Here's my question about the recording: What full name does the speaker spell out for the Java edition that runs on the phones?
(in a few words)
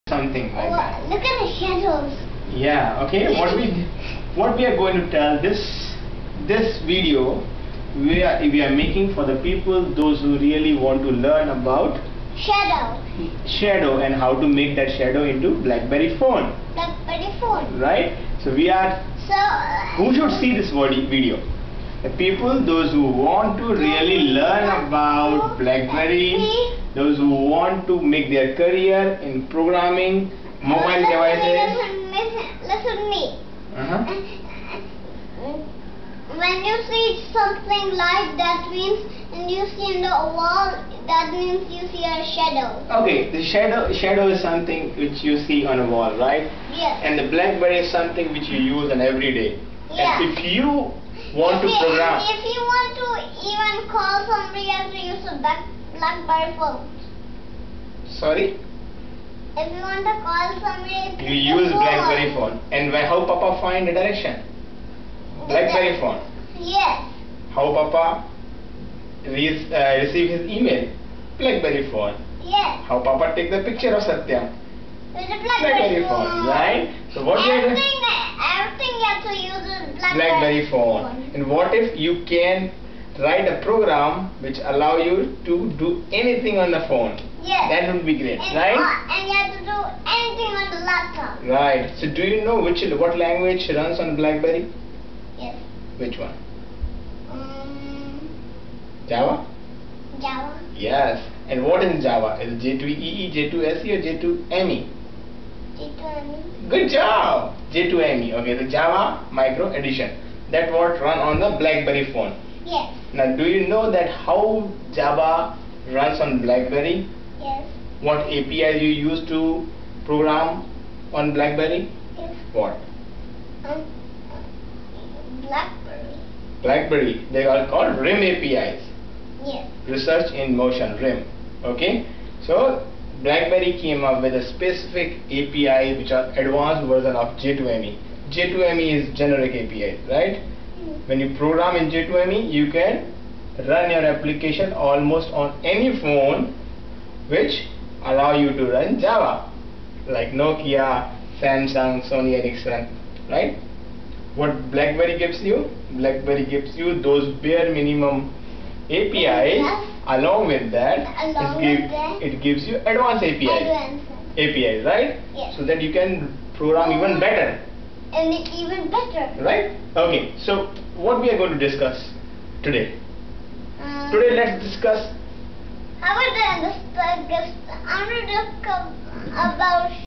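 Java Micro Edition.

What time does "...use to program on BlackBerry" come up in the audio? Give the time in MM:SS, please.
01:59.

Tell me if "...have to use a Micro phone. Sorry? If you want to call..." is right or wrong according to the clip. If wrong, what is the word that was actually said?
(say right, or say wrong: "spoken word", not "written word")
wrong: "BlackBerry", not "Micro".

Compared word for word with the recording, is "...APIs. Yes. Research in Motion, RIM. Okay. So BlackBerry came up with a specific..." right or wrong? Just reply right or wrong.
right.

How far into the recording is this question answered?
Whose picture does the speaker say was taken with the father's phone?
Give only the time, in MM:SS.
01:14.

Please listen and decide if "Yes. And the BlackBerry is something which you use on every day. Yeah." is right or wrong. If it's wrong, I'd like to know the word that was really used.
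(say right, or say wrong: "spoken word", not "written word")
right.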